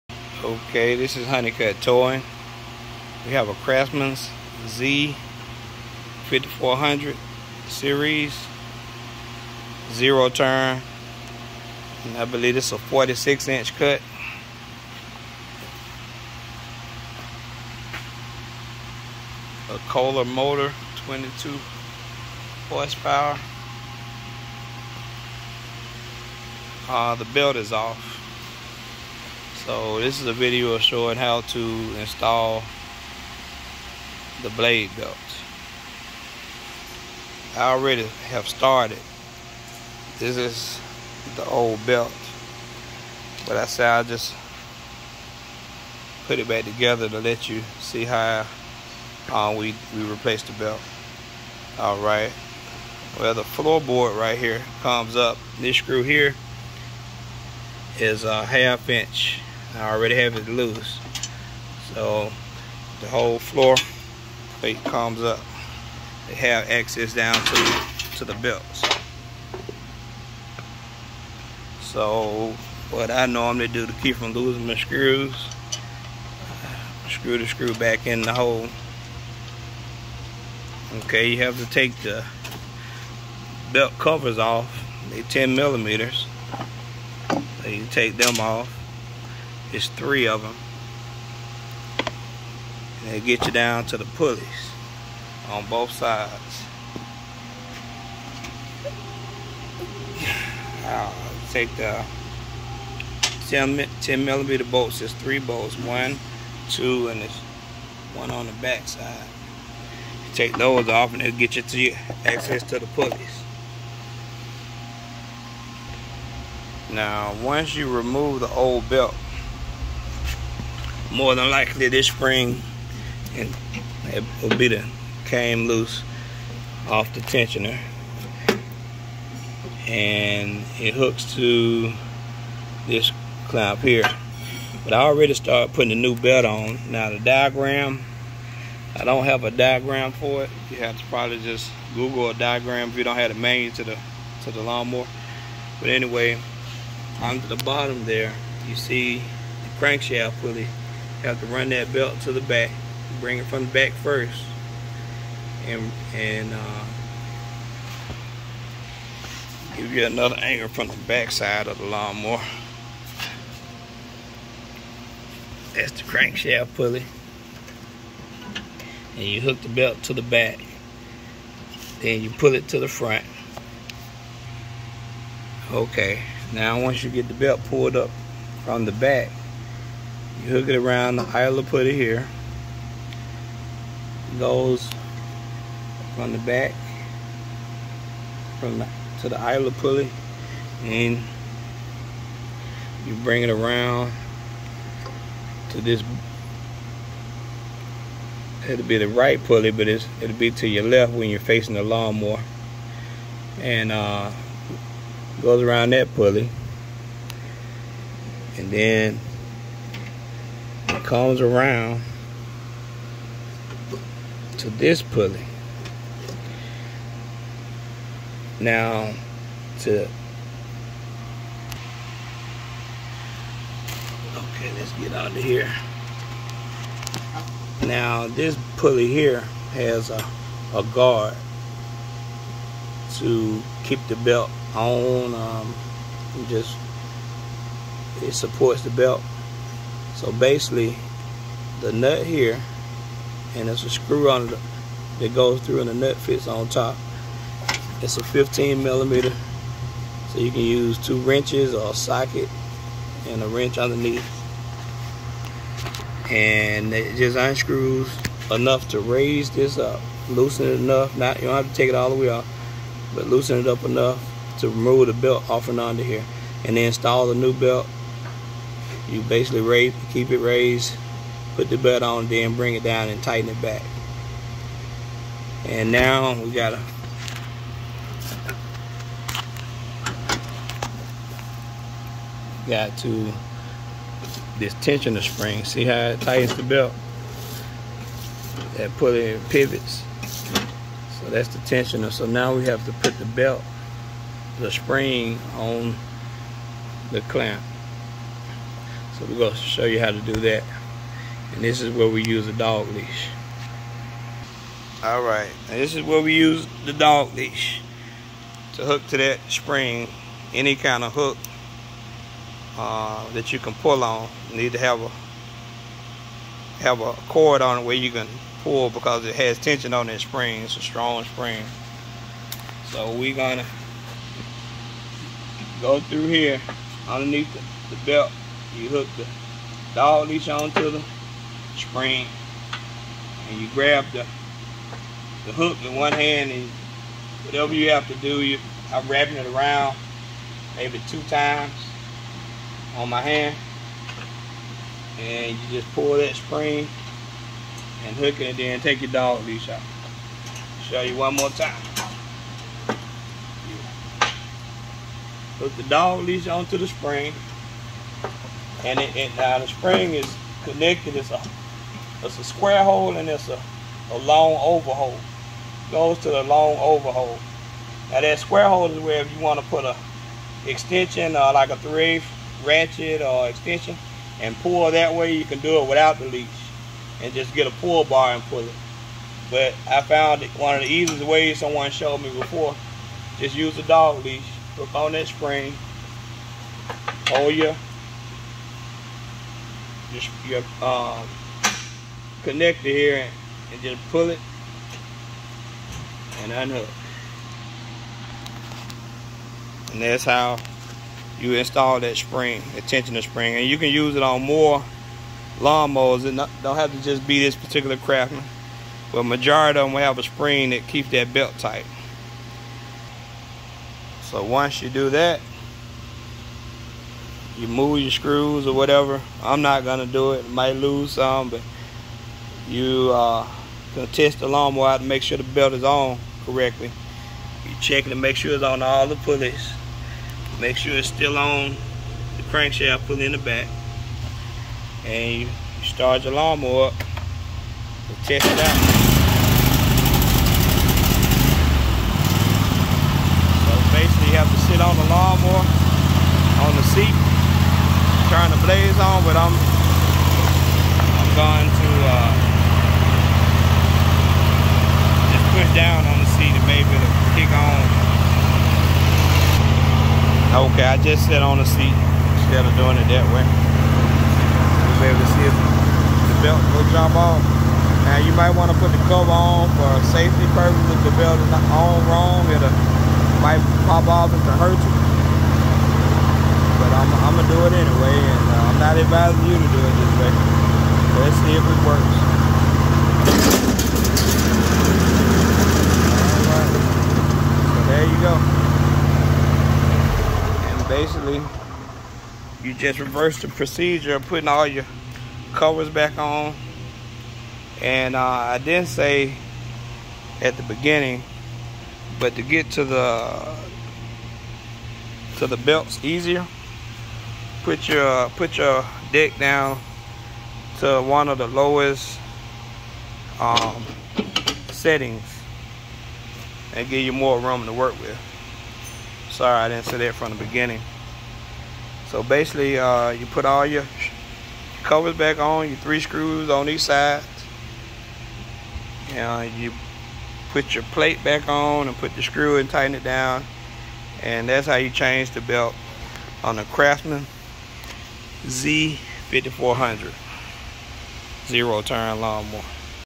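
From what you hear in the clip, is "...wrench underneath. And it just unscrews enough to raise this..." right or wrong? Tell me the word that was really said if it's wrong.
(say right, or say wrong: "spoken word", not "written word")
right.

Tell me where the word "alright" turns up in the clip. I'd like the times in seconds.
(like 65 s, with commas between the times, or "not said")
51 s, 305 s, 486 s.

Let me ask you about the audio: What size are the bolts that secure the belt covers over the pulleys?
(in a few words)
10 millimeters.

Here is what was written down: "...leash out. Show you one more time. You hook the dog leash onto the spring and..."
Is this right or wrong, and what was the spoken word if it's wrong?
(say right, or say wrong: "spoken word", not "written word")
right.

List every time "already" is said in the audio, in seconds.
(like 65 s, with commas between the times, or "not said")
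37 s, 59 s, 135 s.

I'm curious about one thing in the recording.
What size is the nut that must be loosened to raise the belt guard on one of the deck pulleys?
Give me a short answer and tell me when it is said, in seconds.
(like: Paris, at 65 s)
15 millimeter, at 248 s.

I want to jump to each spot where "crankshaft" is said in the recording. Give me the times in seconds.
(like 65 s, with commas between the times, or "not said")
149 s, 166 s, 432 s.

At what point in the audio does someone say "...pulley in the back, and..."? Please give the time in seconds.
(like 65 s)
433 s.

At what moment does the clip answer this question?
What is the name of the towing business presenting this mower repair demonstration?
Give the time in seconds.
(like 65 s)
1 s.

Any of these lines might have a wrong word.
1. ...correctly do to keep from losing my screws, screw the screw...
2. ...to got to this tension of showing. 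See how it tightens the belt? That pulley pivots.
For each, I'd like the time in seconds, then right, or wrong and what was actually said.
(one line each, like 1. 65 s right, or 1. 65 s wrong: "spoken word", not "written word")
1. 73 s wrong: "normally", not "correctly"
2. 276 s wrong: "spring", not "showing".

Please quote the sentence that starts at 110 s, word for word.
You take those off and it'll get you to your access to the pulleys.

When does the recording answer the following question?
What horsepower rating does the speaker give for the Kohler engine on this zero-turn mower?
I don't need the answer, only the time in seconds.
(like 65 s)
21 s.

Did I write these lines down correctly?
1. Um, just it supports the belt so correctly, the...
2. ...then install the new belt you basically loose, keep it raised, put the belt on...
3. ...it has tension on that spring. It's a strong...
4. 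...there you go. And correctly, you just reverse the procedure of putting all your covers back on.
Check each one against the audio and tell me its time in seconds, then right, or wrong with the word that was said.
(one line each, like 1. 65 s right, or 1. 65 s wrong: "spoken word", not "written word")
1. 235 s wrong: "basically", not "correctly"
2. 266 s wrong: "raise", not "loose"
3. 319 s right
4. 487 s wrong: "basically", not "correctly".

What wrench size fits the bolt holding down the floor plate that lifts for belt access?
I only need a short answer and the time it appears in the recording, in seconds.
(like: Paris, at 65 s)
half inch, at 58 s.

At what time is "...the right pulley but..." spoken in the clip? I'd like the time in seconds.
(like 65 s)
198 s.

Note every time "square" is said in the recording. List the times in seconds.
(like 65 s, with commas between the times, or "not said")
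362 s, 368 s.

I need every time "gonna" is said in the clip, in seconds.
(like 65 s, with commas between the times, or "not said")
323 s, 419 s, 423 s.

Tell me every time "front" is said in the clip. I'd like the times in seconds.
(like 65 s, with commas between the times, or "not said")
172 s.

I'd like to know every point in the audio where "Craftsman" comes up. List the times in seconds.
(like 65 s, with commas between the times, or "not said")
3 s, 407 s, 536 s.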